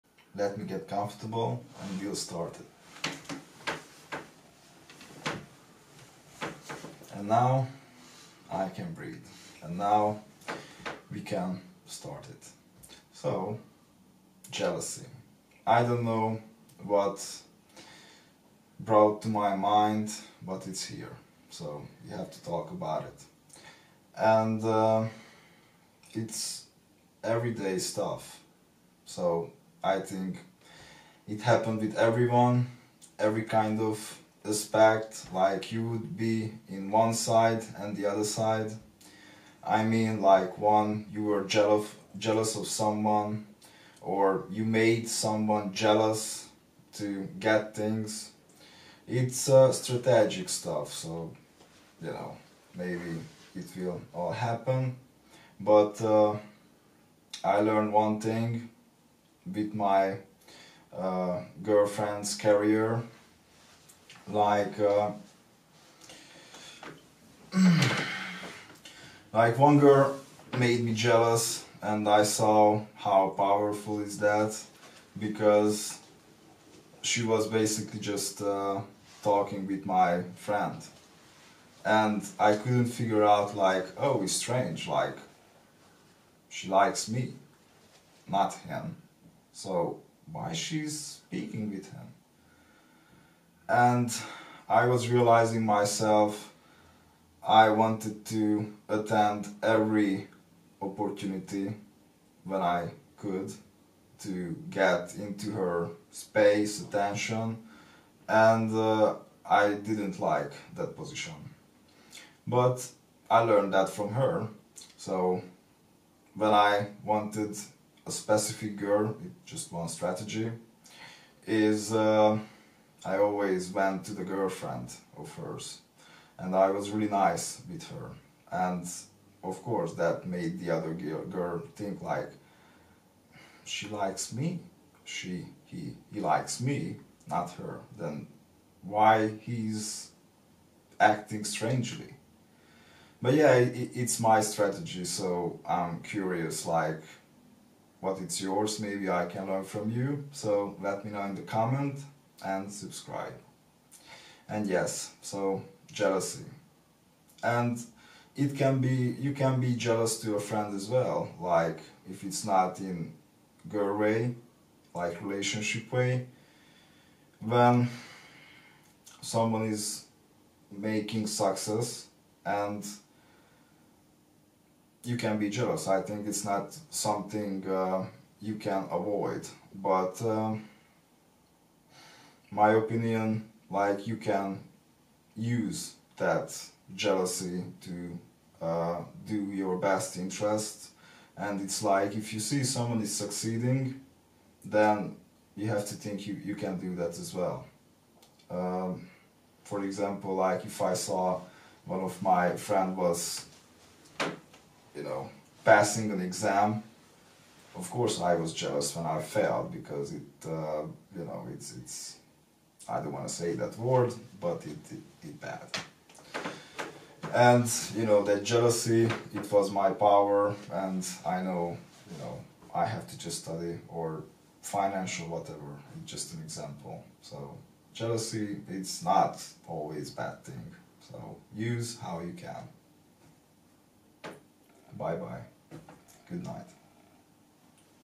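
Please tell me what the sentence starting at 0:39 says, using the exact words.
I mean, like one, you were jealous, jealous of someone, or you made someone jealous to get things.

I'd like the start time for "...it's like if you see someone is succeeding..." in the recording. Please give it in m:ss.
3:11.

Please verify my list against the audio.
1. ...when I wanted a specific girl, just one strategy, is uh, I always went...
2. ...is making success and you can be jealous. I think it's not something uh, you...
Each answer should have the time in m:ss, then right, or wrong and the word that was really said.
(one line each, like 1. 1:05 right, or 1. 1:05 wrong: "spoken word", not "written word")
1. 1:56 right
2. 2:49 right.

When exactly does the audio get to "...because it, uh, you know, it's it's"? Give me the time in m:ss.
3:29.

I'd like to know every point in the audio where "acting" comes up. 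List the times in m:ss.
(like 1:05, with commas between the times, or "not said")
2:20.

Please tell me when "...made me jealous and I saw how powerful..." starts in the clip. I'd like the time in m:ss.
1:10.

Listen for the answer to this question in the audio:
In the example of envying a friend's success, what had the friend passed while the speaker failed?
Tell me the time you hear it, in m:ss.
3:26.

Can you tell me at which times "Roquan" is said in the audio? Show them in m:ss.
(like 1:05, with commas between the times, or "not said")
not said.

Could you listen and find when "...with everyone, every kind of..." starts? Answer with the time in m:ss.
0:31.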